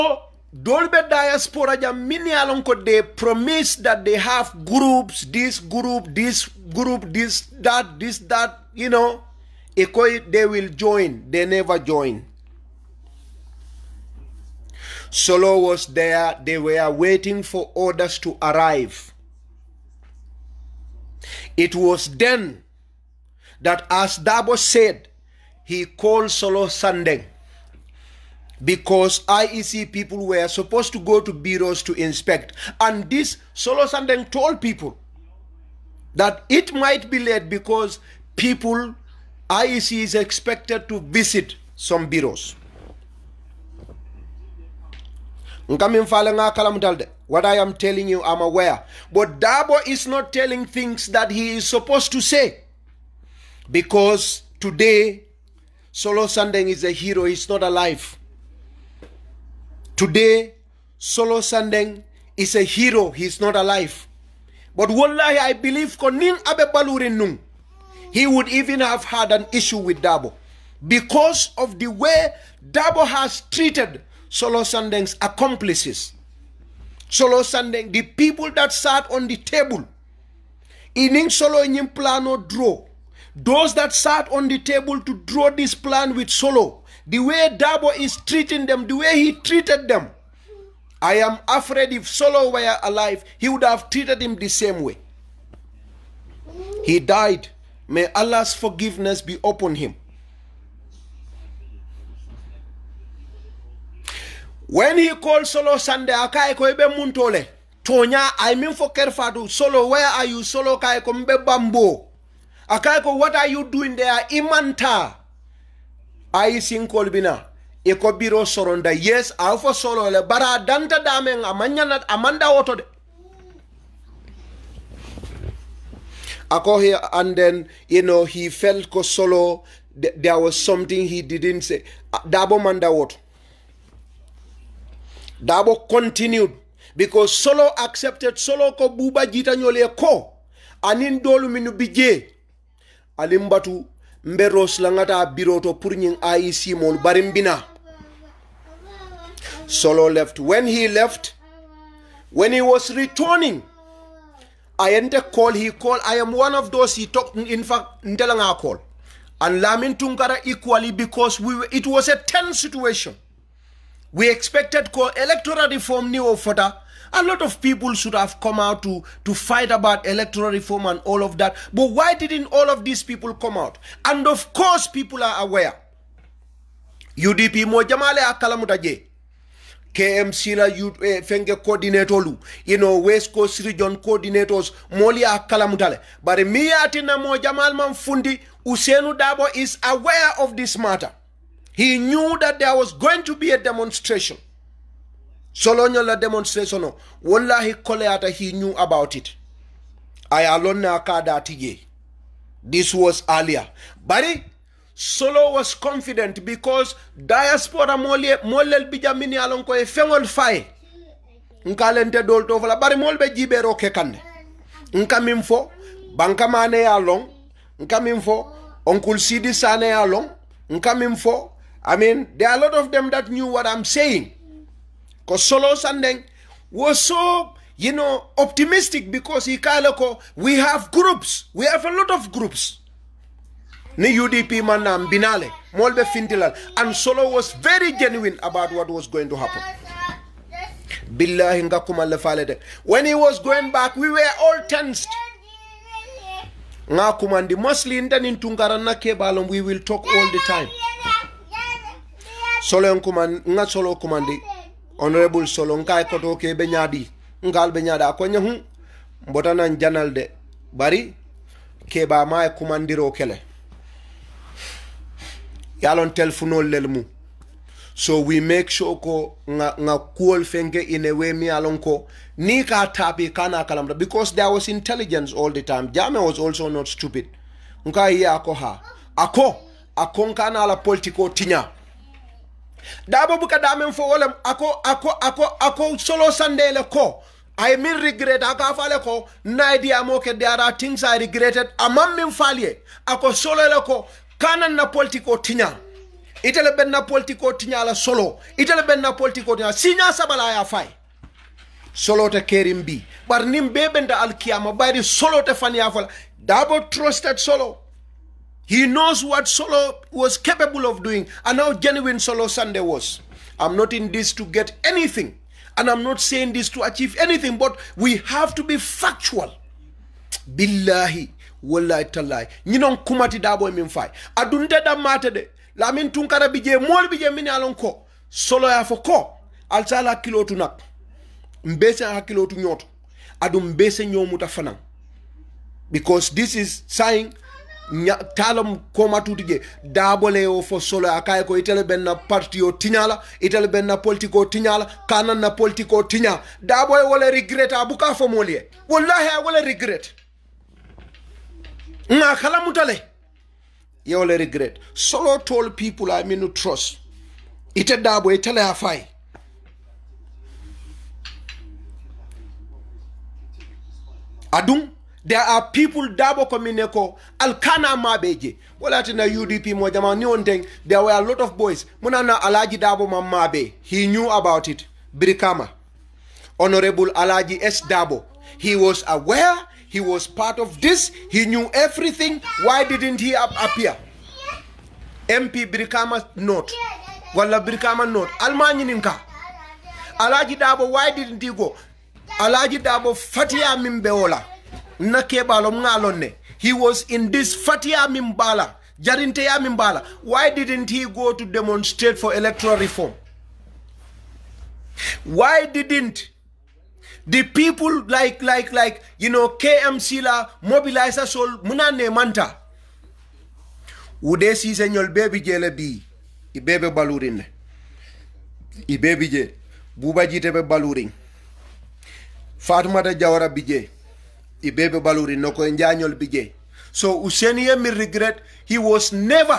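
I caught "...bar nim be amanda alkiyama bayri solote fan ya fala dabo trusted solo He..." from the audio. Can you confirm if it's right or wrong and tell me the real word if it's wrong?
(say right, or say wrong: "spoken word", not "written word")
wrong: "benda", not "amanda".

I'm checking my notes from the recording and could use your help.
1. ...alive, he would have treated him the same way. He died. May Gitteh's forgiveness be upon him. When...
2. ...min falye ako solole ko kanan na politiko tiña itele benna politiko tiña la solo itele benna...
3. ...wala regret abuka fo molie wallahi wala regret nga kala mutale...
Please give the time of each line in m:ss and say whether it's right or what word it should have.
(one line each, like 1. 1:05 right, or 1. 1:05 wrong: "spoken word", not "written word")
1. 1:32 wrong: "Allah", not "Gitteh"
2. 4:52 right
3. 5:47 right.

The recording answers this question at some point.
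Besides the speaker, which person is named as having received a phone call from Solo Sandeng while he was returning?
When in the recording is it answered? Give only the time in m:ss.
2:39.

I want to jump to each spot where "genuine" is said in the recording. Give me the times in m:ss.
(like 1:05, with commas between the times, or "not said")
3:57, 5:11.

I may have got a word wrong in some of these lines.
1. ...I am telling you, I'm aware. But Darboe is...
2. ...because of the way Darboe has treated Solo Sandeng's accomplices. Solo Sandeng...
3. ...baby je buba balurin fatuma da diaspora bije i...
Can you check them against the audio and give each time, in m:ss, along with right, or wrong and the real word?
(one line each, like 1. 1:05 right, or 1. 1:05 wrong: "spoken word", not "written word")
1. 0:45 right
2. 1:10 right
3. 6:58 wrong: "jawara", not "diaspora".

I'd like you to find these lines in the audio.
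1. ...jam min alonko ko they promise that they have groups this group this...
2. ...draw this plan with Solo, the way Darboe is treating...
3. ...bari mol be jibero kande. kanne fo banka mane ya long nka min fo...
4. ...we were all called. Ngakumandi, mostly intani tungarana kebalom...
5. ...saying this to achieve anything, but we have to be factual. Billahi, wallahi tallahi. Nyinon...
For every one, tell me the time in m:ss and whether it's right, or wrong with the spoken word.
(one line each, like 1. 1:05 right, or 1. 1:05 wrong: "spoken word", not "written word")
1. 0:01 right
2. 1:25 right
3. 3:32 right
4. 4:03 wrong: "tensed", not "called"
5. 5:16 right.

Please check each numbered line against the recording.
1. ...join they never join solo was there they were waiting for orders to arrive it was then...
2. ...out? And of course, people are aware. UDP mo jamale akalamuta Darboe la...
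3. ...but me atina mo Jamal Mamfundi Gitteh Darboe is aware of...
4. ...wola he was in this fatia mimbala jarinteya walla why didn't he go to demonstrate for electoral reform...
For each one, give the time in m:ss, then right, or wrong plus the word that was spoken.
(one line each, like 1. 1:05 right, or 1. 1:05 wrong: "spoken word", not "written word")
1. 0:10 right
2. 2:53 wrong: "KMC", not "Darboe"
3. 3:06 wrong: "Ousainou", not "Gitteh"
4. 6:34 wrong: "mimbala", not "walla".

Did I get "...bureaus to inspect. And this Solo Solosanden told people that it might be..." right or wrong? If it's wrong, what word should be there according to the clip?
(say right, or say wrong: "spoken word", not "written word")
right.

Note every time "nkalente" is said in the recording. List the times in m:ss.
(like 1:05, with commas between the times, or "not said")
3:31.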